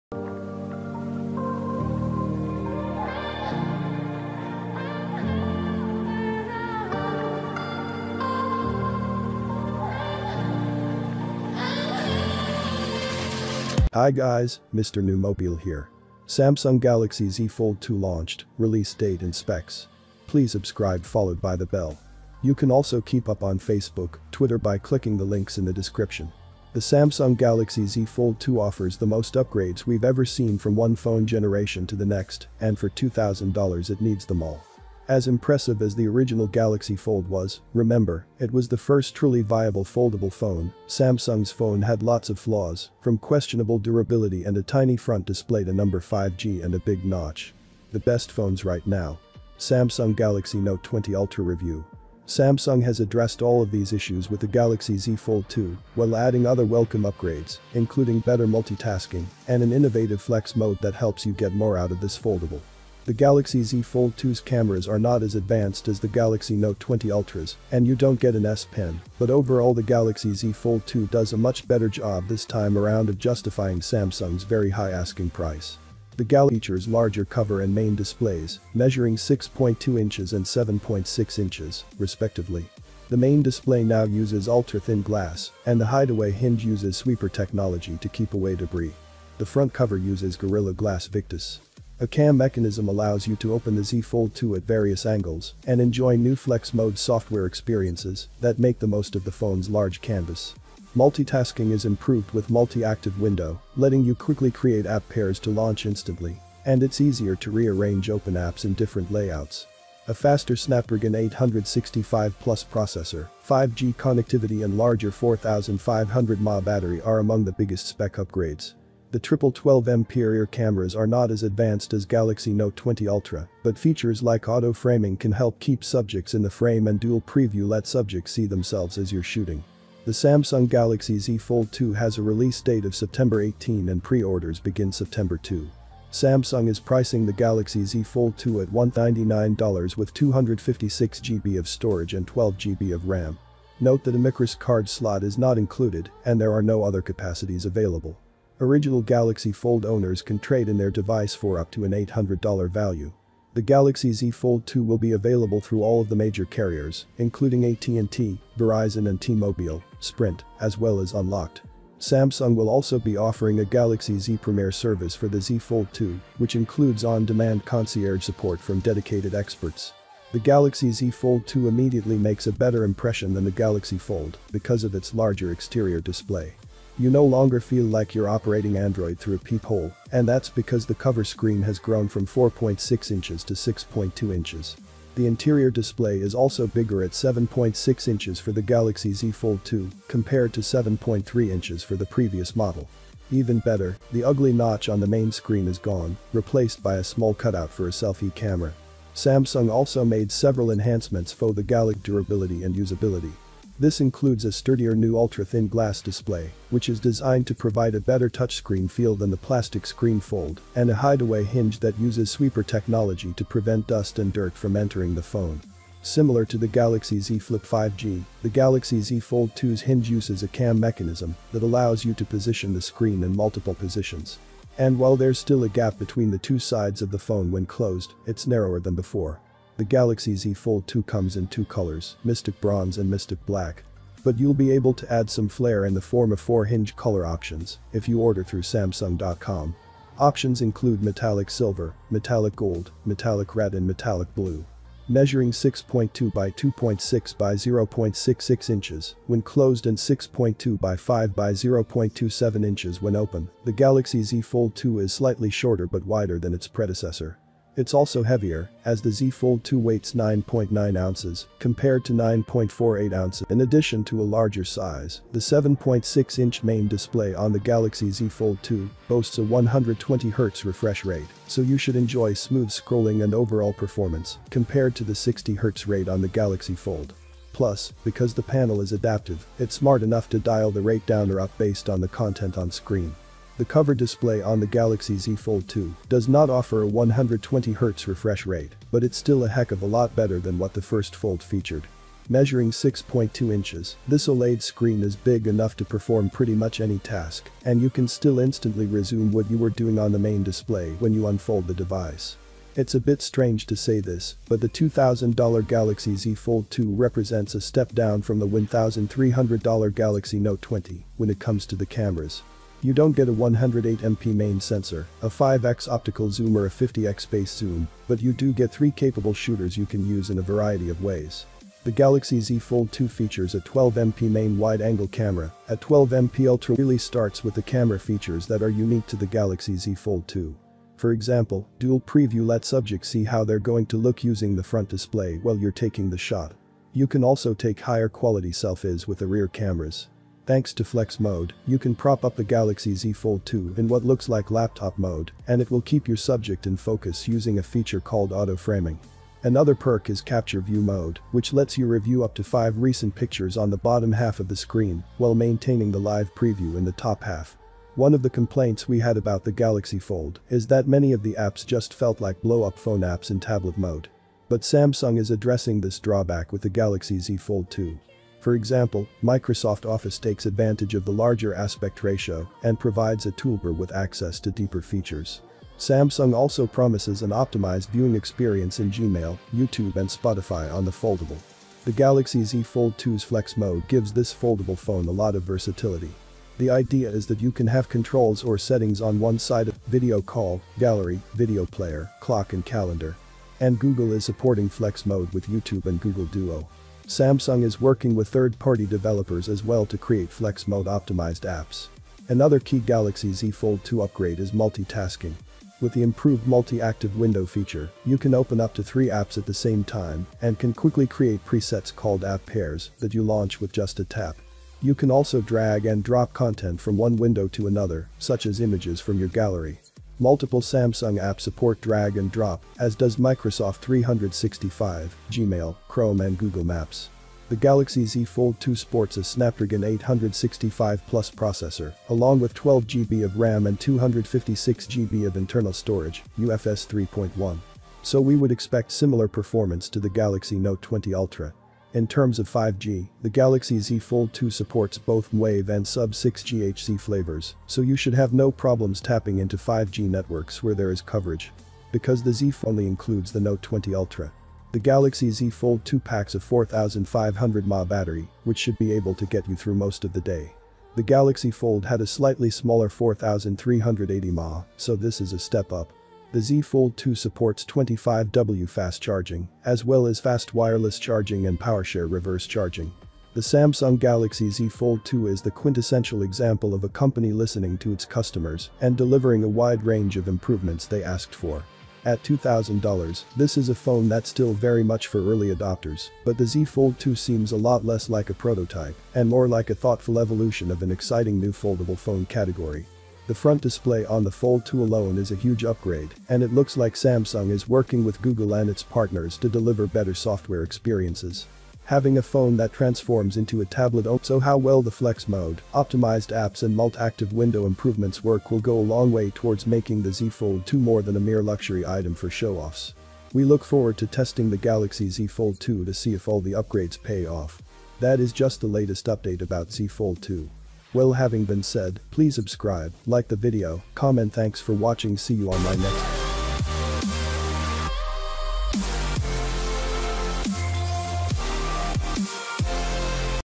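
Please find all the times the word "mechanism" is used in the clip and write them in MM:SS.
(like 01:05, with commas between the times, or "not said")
01:32, 03:40.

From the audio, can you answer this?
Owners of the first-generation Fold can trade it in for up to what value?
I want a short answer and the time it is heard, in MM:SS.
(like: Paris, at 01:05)
$800, at 02:31.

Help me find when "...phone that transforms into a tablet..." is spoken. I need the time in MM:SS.
08:22.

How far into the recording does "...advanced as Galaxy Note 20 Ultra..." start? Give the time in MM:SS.
02:01.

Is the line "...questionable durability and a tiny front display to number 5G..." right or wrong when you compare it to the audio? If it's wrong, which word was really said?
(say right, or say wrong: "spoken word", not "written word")
right.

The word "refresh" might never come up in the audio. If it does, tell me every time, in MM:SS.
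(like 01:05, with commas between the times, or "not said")
04:30, 04:48.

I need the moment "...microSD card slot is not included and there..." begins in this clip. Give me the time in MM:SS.
02:24.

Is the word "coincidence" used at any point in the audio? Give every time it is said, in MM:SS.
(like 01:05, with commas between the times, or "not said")
not said.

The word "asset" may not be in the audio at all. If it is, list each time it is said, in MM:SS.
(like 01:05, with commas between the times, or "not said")
not said.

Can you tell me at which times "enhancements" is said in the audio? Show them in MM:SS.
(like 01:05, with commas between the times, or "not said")
03:20.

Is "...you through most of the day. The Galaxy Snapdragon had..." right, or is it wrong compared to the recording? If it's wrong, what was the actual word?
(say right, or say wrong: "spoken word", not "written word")
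wrong: "Fold", not "Snapdragon".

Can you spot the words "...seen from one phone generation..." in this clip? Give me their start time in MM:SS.
00:30.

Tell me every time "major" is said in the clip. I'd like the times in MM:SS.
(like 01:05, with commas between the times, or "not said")
02:36.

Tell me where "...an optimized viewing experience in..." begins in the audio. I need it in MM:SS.
06:17.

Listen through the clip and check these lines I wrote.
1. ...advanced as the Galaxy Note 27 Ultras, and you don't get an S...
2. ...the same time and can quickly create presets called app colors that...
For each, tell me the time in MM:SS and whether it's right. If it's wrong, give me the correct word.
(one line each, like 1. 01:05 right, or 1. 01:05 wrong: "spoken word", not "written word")
1. 01:05 wrong: "20", not "27"
2. 06:49 wrong: "pairs", not "colors".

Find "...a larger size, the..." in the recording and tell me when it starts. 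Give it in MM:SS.
04:24.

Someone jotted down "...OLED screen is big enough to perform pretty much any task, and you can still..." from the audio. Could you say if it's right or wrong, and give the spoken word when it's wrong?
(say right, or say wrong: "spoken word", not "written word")
right.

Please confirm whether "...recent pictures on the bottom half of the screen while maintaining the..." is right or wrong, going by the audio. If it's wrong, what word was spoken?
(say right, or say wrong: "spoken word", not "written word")
right.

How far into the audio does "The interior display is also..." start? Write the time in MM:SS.
03:05.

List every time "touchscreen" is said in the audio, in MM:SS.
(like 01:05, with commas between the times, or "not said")
03:28.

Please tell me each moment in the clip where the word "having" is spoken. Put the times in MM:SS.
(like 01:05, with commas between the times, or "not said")
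08:21, 08:41.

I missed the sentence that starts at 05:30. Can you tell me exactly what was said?
For example, dual preview lets subjects see how they're going to look using the front display while you're taking the shot.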